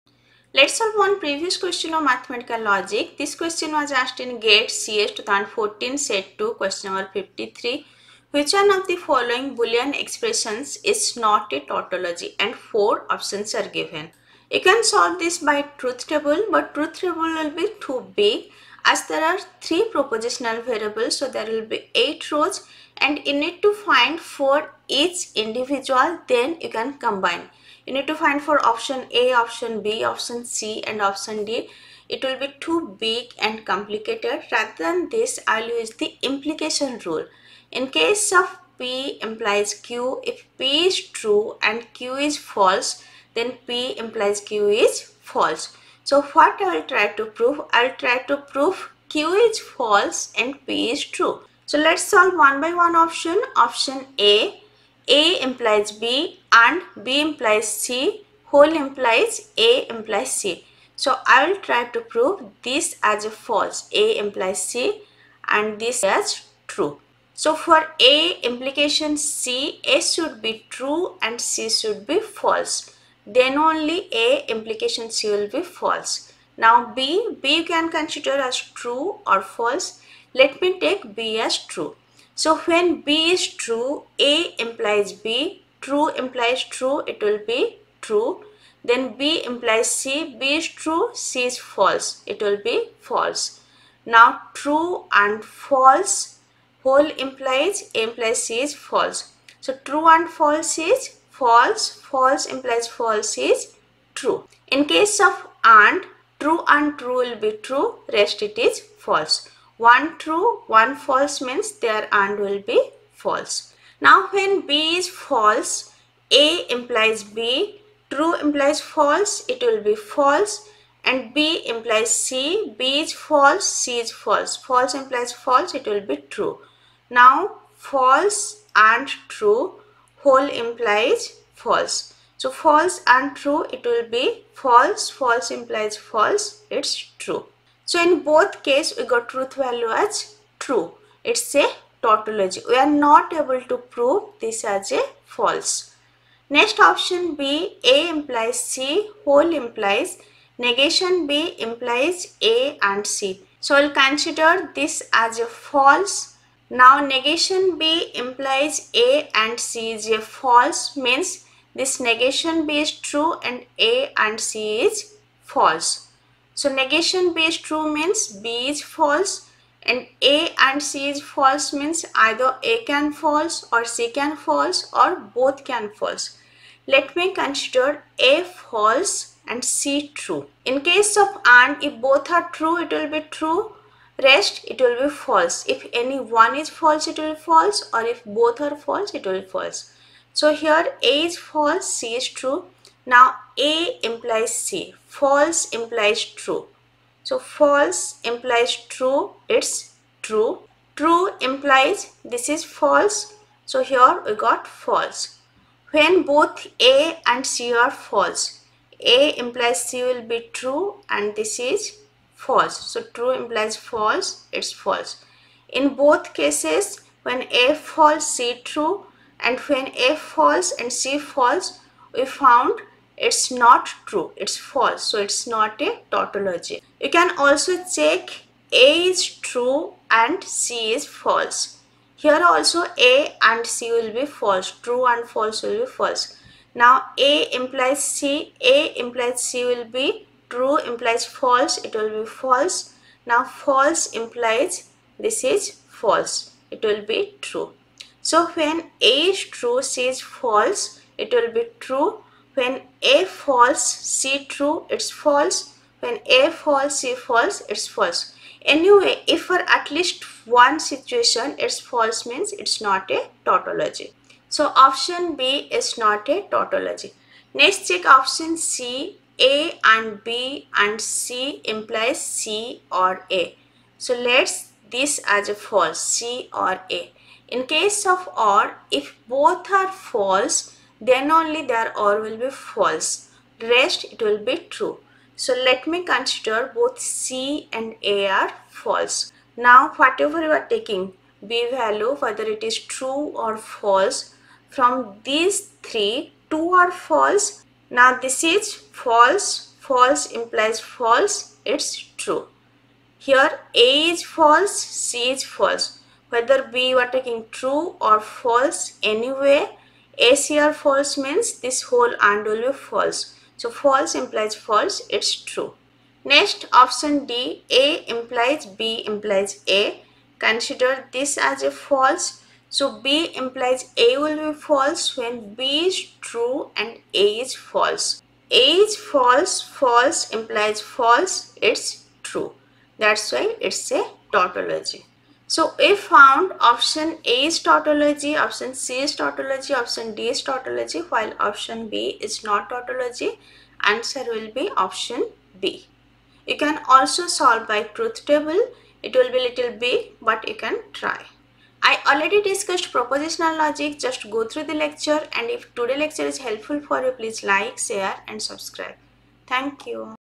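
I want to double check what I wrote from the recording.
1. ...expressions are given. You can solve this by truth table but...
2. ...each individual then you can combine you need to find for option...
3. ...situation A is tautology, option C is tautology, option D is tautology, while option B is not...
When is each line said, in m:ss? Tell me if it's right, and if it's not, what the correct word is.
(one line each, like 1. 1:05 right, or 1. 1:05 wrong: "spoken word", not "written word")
1. 0:13 wrong: "options", not "expressions"
2. 0:24 right
3. 5:36 wrong: "option", not "situation".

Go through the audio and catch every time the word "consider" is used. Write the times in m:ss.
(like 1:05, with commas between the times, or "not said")
1:17, 2:33, 2:57, 4:46, 5:20.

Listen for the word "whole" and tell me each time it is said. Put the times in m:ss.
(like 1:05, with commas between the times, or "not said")
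0:58, 1:36, 2:10, 2:29, 5:11.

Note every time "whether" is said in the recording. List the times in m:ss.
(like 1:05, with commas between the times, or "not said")
4:52, 5:06.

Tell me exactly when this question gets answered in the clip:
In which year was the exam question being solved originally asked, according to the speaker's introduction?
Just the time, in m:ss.
0:05.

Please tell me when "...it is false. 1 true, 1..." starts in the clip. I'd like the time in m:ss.
1:48.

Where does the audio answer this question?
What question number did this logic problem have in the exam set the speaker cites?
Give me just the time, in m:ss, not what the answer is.
0:07.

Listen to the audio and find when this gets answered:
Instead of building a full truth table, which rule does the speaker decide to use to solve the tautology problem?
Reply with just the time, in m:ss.
0:36.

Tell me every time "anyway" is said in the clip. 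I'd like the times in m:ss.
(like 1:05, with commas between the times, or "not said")
4:18, 5:09.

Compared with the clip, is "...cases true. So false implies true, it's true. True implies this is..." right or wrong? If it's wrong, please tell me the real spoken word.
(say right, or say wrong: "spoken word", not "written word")
wrong: "implies", not "cases".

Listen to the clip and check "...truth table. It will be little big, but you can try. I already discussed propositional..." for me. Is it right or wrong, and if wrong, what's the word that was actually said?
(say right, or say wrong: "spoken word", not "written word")
right.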